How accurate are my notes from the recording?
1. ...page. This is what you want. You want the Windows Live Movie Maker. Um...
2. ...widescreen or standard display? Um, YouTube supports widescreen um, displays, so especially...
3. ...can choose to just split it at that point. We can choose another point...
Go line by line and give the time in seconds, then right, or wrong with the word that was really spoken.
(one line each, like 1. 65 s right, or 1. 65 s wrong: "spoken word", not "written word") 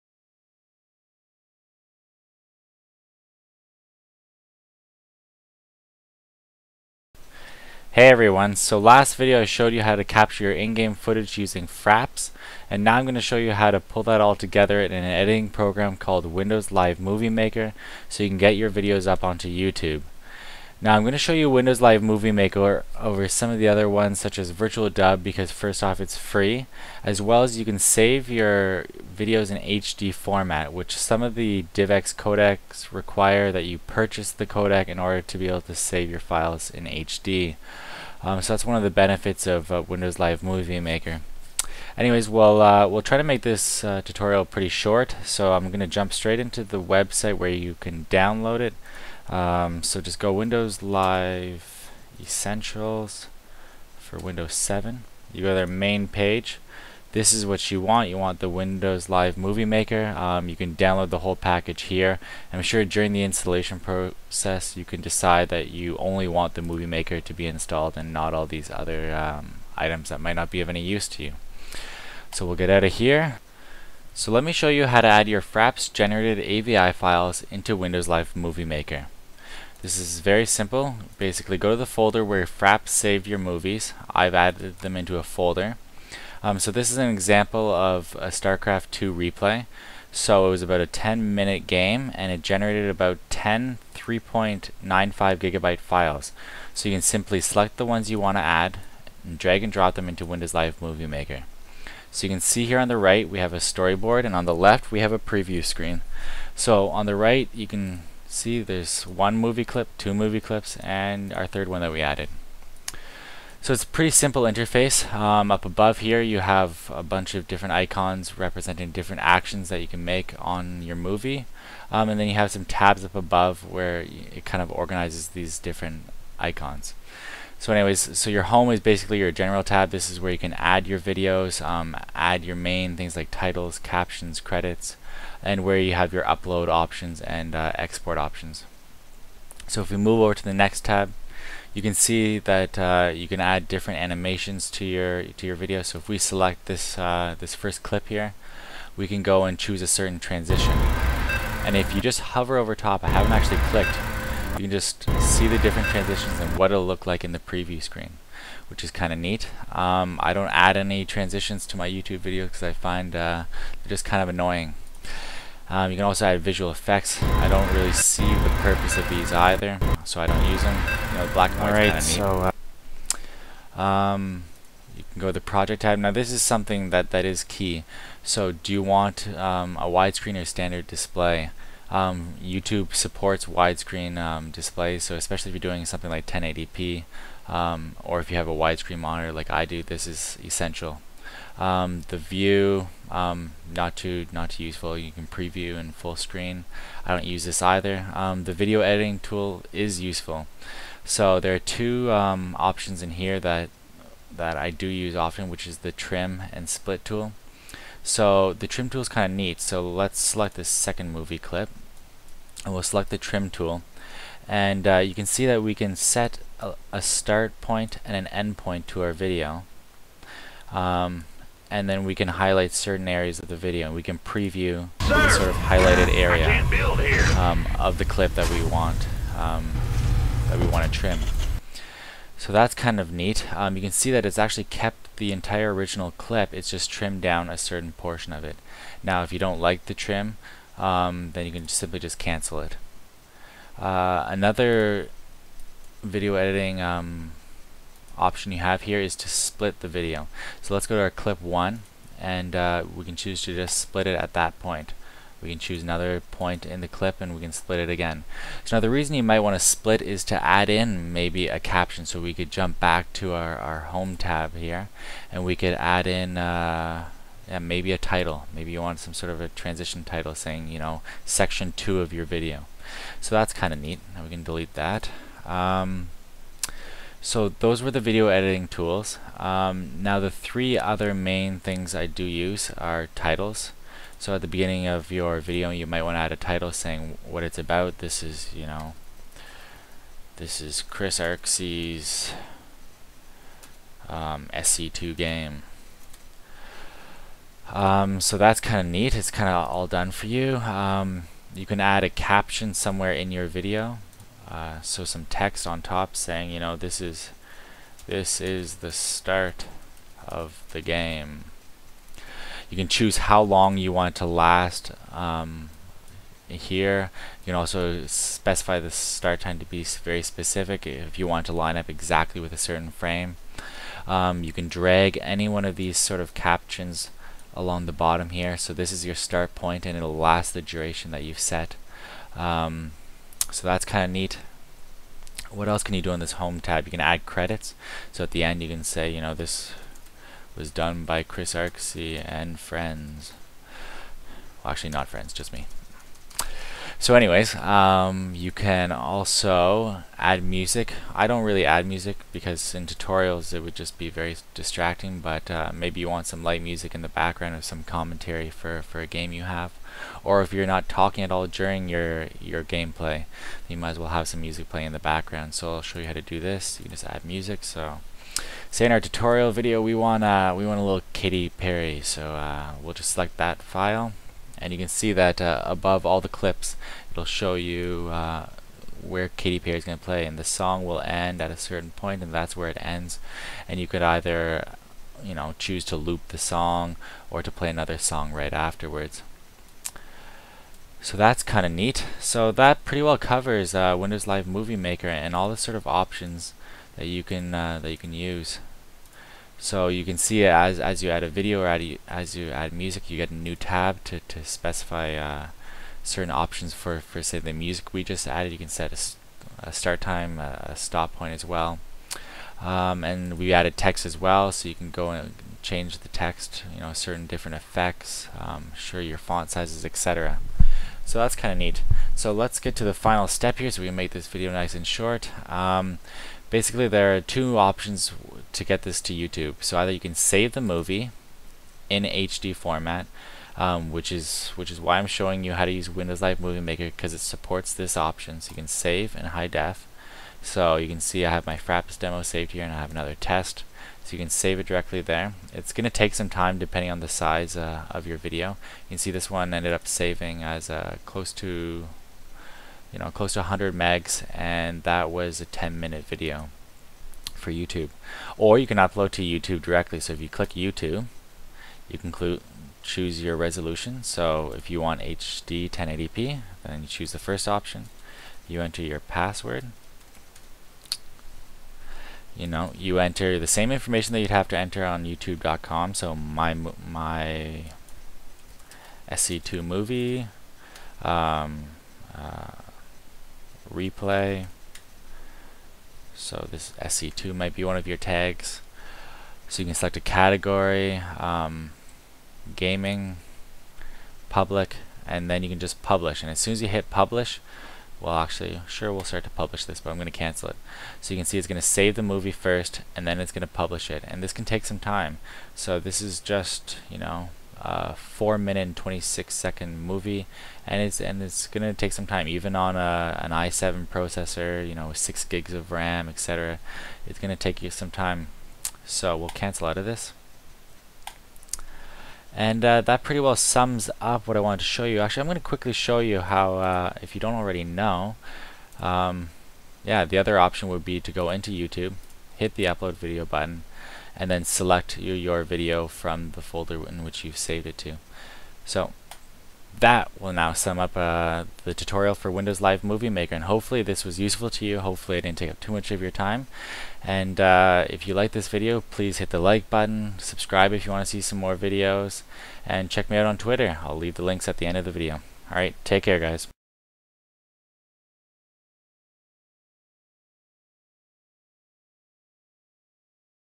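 1. 56 s right
2. 179 s right
3. 253 s right.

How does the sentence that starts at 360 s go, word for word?
Or if you're not talking at all during your, your gameplay, you might as well have some music playing in the background.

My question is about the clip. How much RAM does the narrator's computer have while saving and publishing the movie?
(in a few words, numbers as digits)
6 gigs.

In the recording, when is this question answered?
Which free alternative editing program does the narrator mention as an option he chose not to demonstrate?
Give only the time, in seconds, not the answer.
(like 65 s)
24 s.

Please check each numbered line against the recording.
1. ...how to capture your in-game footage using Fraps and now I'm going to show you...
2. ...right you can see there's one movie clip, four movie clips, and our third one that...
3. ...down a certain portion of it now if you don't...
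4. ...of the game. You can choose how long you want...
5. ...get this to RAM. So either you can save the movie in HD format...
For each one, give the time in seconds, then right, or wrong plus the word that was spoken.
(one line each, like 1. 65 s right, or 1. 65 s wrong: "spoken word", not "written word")
1. 9 s right
2. 107 s wrong: "two", not "four"
3. 237 s right
4. 310 s right
5. 428 s wrong: "YouTube", not "RAM".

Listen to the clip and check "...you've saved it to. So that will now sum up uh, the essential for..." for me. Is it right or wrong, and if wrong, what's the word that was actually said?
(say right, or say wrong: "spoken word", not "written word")
wrong: "tutorial", not "essential".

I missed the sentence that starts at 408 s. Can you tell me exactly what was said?
You can set a, a start time, a, stop point as well.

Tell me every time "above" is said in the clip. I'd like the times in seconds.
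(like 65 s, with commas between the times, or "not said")
115 s, 123 s, 375 s.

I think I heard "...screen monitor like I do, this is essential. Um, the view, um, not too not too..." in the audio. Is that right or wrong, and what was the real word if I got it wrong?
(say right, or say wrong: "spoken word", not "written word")
wrong: "widescreen", not "screen".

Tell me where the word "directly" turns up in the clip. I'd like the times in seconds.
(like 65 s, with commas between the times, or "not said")
444 s, 459 s.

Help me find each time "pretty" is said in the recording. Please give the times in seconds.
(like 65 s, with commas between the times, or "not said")
44 s, 113 s, 392 s, 523 s.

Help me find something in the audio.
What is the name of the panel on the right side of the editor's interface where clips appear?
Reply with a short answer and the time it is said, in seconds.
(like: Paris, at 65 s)
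storyboard, at 103 s.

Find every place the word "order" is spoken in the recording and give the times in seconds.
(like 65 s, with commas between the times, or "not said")
34 s.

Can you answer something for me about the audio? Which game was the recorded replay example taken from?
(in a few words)
StarCraft 2.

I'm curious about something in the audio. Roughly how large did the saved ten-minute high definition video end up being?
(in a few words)
100 megs.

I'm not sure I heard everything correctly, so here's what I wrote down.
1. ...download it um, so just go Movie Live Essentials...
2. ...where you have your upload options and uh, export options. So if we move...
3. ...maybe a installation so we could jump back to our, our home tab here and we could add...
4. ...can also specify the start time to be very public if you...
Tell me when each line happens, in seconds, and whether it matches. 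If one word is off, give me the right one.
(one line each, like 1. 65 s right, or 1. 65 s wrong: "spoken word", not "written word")
1. 48 s wrong: "Windows", not "Movie"
2. 135 s right
3. 261 s wrong: "caption", not "installation"
4. 317 s wrong: "specific", not "public".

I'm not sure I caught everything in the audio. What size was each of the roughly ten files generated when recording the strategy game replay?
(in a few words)
3.95 gigabytes.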